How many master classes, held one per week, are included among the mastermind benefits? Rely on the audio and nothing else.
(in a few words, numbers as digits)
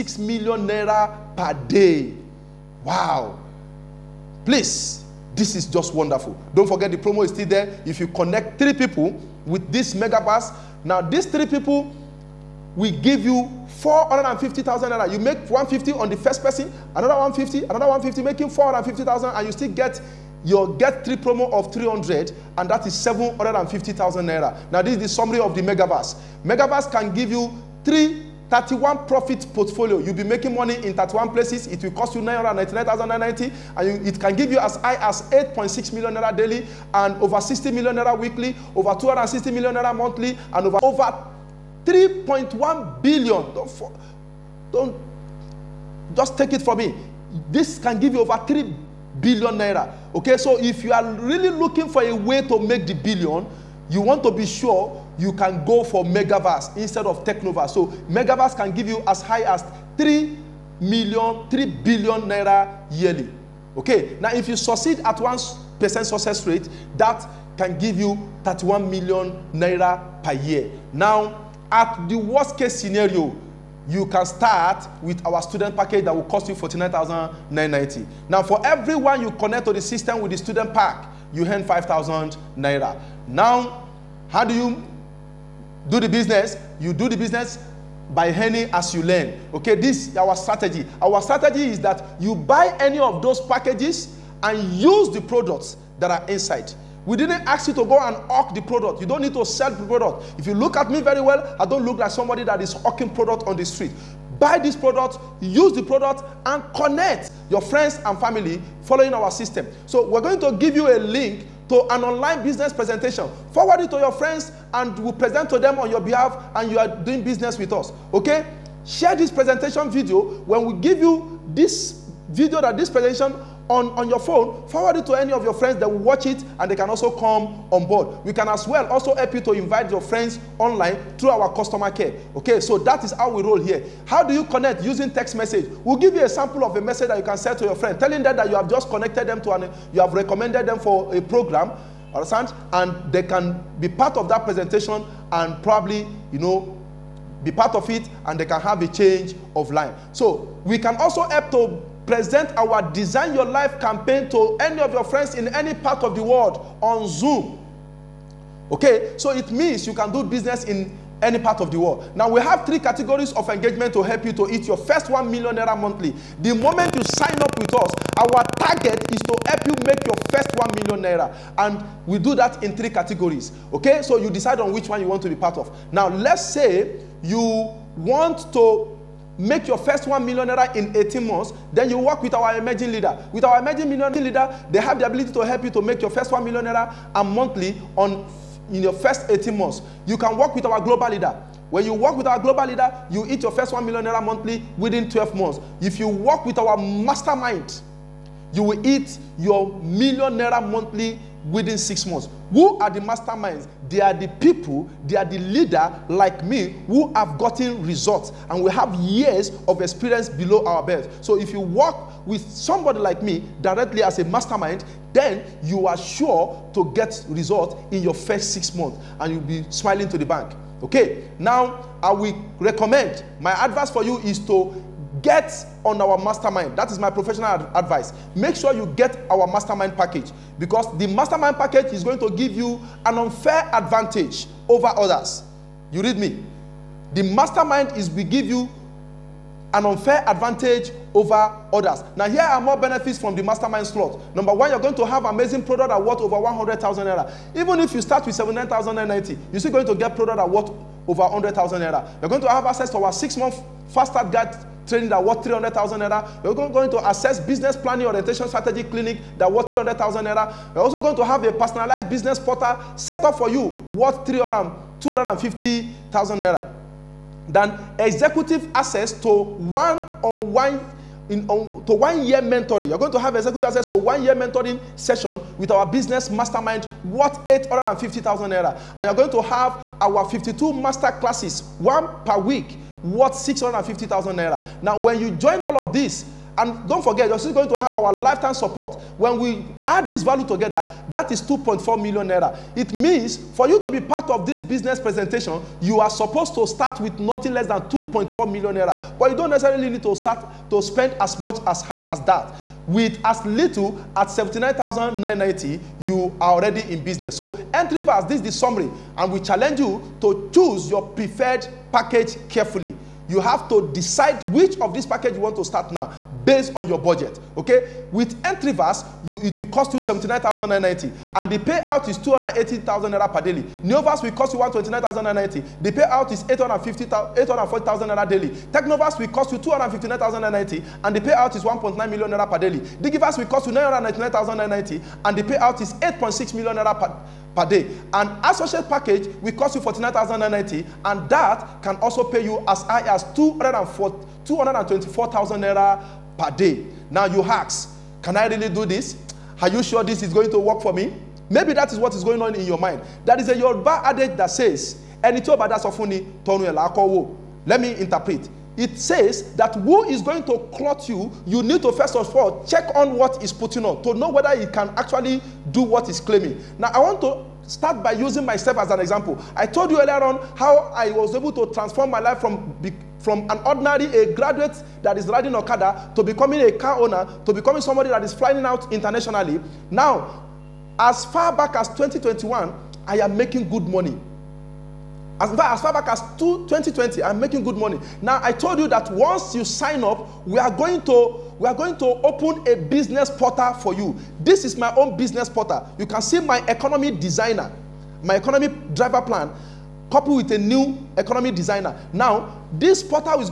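52.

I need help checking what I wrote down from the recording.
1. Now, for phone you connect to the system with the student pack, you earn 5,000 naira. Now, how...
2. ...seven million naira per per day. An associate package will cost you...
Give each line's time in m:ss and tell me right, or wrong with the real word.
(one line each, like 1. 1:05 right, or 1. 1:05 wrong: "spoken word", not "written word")
1. 1:18 wrong: "everyone", not "phone"
2. 5:36 wrong: "six", not "seven".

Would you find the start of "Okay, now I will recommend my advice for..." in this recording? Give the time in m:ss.
3:40.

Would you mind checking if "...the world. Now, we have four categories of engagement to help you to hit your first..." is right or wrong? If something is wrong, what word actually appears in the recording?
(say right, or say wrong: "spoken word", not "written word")
wrong: "three", not "four".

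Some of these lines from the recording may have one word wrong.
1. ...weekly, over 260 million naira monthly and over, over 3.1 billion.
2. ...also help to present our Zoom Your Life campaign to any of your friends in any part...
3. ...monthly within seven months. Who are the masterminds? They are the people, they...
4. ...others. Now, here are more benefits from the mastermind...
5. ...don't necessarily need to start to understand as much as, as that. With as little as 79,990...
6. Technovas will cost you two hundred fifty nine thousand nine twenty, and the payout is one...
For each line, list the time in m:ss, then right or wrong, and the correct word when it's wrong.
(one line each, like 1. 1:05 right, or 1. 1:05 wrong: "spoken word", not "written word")
1. 0:38 right
2. 2:30 wrong: "Design", not "Zoom"
3. 3:20 wrong: "six", not "seven"
4. 4:01 right
5. 4:59 wrong: "spend", not "understand"
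6. 5:28 wrong: "ninety", not "twenty".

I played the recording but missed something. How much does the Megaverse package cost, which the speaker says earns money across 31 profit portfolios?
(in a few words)
999,990.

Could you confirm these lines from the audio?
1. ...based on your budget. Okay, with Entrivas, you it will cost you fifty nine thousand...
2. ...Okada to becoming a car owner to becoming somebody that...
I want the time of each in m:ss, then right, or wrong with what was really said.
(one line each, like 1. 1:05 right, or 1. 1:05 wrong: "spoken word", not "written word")
1. 5:16 wrong: "seventy", not "fifty"
2. 6:15 right.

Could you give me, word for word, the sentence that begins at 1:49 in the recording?
So we're going to give you a link to an online business presentation.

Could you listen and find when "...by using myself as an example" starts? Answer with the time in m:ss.
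6:08.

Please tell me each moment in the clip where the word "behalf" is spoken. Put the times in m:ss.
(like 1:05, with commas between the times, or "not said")
1:56.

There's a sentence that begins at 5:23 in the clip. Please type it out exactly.
Neovas will cost you one twenty nine thousand nine ninety.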